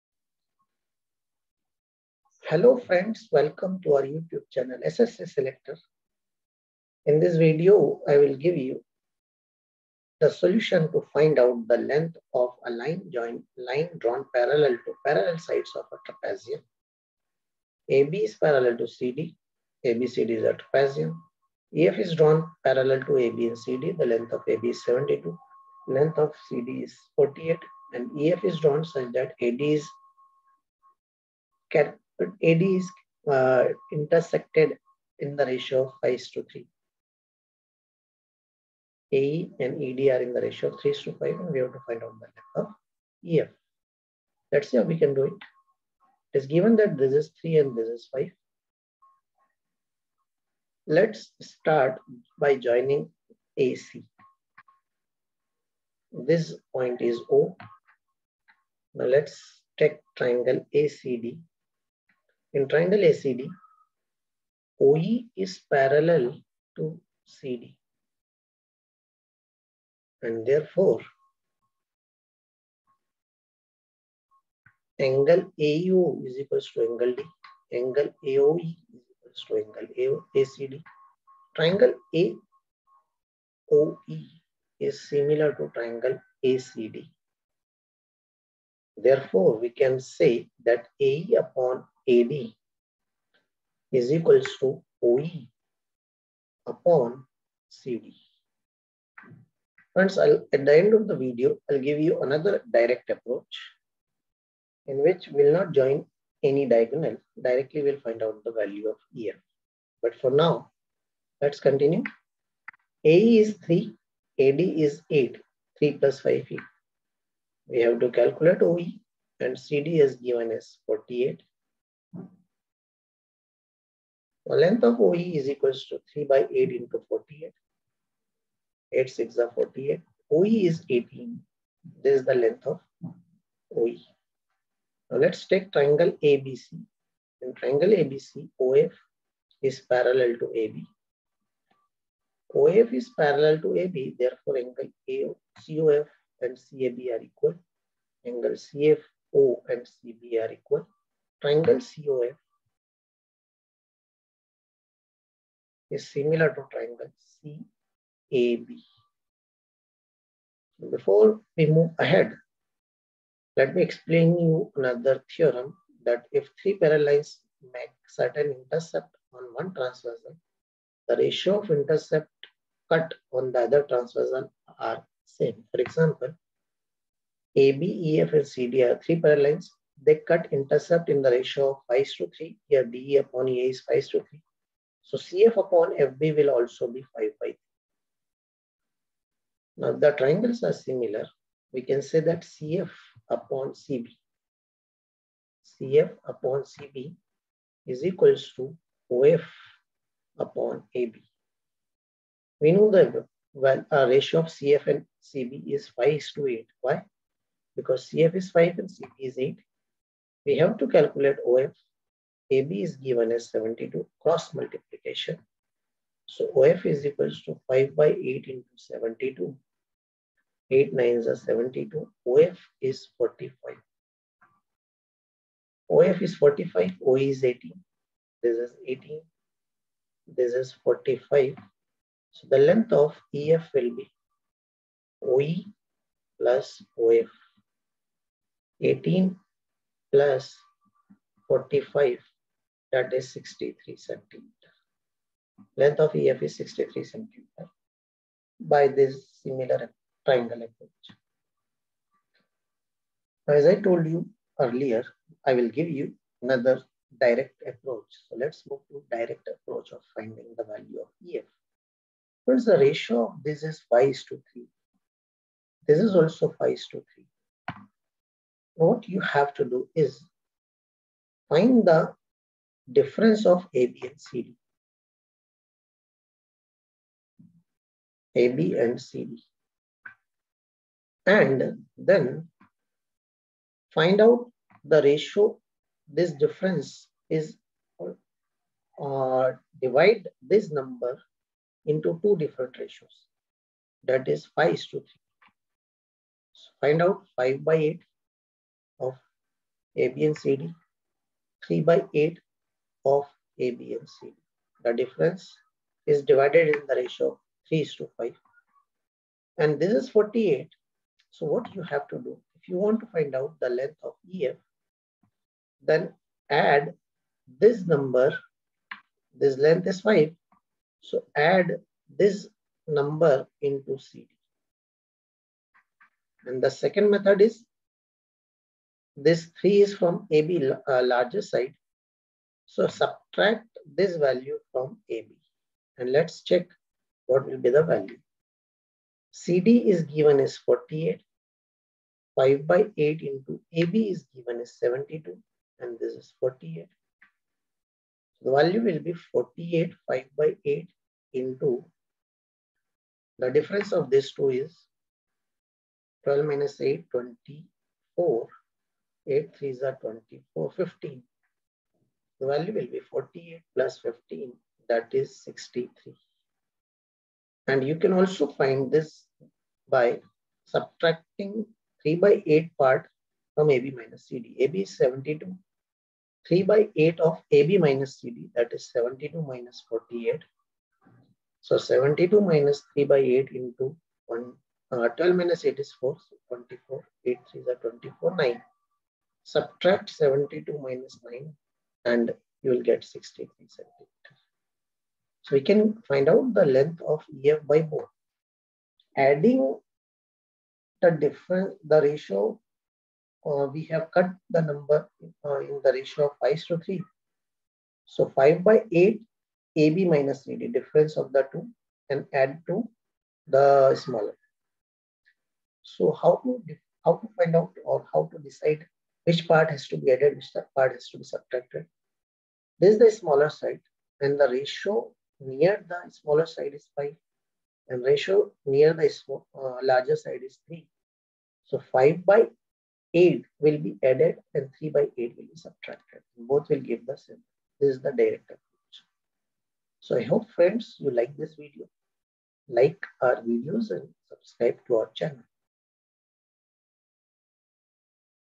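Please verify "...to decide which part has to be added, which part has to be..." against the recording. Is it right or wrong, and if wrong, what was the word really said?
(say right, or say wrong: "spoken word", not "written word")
right.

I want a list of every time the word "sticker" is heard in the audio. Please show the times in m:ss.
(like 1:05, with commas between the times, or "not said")
not said.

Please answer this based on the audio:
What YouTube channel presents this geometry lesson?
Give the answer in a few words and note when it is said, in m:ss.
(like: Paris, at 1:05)
SSC Selector, at 0:04.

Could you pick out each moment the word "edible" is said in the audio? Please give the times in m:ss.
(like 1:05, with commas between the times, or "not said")
not said.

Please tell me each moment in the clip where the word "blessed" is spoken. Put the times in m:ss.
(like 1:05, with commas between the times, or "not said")
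not said.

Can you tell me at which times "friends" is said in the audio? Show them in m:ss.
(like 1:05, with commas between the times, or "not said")
0:02, 1:39, 7:20.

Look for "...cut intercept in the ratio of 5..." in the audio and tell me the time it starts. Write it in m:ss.
3:00.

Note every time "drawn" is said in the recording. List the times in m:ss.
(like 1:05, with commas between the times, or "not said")
0:13, 0:22, 0:28.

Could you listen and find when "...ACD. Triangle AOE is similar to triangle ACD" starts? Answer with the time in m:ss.
1:20.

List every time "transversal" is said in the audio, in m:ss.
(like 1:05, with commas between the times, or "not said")
2:49, 2:53.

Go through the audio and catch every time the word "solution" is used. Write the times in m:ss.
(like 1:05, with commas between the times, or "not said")
0:10.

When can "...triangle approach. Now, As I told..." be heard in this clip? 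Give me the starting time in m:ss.
4:10.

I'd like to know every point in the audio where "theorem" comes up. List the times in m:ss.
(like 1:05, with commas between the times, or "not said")
2:45.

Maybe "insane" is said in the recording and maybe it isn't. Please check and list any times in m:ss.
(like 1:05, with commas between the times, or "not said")
not said.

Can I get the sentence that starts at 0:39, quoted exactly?
AE and ED are in the ratio of 3 to 5, and we have to find out the length of EF.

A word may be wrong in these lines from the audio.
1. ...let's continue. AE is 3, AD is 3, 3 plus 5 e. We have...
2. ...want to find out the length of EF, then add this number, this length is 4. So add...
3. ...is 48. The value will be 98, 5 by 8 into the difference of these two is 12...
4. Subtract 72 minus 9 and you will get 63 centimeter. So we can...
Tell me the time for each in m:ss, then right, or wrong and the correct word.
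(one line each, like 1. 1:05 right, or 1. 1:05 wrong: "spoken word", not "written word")
1. 1:51 wrong: "8", not "3"
2. 5:12 wrong: "5", not "4"
3. 5:46 wrong: "48", not "98"
4. 6:29 right.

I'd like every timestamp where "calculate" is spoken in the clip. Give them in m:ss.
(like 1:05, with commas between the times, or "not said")
1:58, 3:30.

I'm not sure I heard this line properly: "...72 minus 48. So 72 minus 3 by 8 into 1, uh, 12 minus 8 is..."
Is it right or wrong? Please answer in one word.
right.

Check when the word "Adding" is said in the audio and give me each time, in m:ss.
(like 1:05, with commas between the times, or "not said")
6:39.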